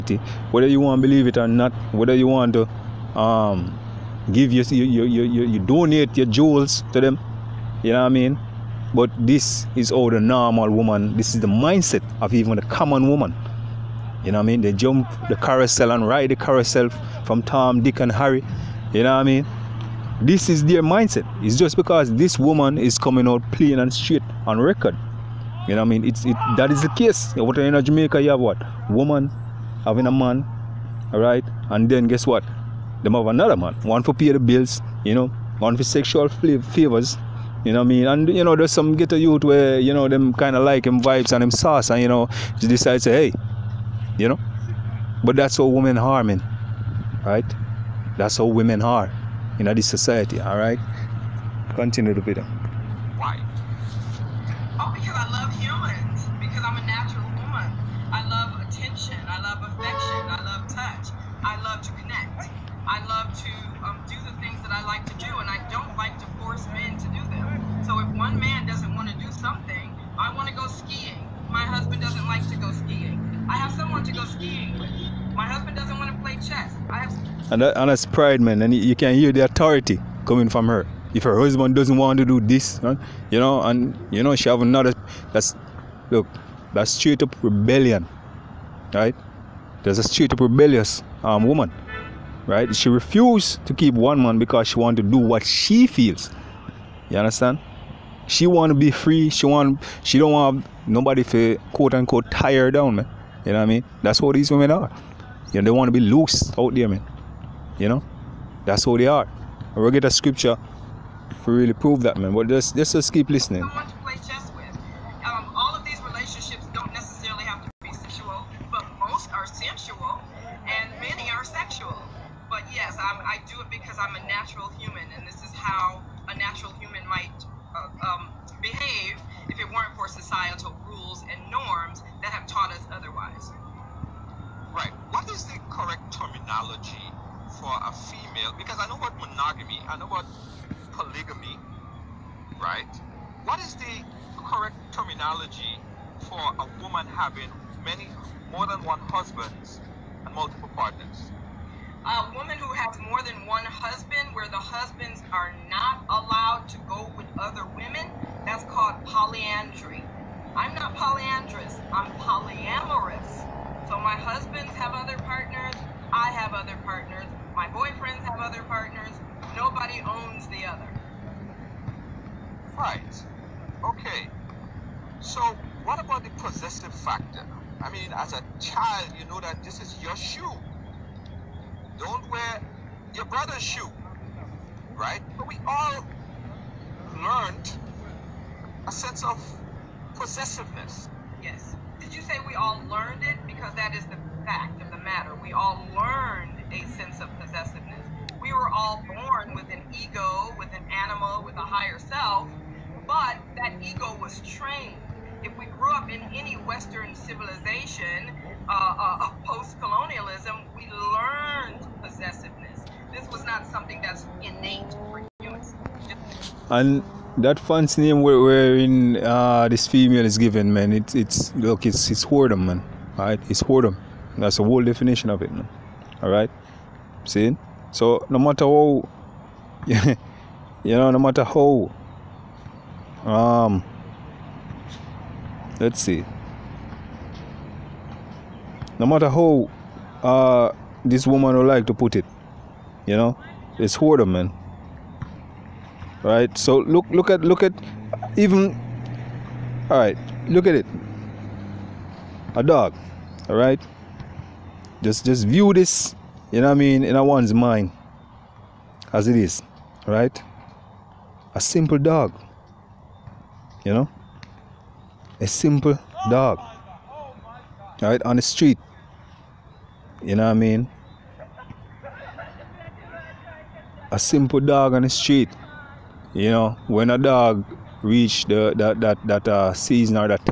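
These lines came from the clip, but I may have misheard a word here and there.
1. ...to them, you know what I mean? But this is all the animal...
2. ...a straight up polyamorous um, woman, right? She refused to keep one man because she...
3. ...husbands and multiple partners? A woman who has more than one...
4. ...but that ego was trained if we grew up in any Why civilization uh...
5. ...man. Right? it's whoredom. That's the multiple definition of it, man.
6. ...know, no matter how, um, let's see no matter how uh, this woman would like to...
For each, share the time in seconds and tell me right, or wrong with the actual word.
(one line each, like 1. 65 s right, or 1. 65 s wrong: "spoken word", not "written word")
1. 6 s wrong: "normal", not "animal"
2. 89 s wrong: "rebellious", not "polyamorous"
3. 149 s right
4. 203 s wrong: "Western", not "Why"
5. 222 s wrong: "whole", not "multiple"
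6. 230 s right.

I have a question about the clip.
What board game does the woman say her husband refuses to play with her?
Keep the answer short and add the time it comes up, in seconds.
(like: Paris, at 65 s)
chess, at 76 s.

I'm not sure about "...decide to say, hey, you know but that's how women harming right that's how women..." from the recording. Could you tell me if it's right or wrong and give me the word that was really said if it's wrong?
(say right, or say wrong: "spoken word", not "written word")
right.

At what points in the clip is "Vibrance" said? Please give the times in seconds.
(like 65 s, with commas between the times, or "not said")
not said.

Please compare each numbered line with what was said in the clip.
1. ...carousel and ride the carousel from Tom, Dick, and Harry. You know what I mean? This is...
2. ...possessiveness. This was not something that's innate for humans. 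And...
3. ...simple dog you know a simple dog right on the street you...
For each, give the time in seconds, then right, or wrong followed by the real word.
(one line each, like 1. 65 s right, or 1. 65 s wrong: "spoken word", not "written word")
1. 15 s right
2. 212 s right
3. 261 s right.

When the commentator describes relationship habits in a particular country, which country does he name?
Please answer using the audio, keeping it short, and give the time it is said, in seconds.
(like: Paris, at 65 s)
Jamaica, at 27 s.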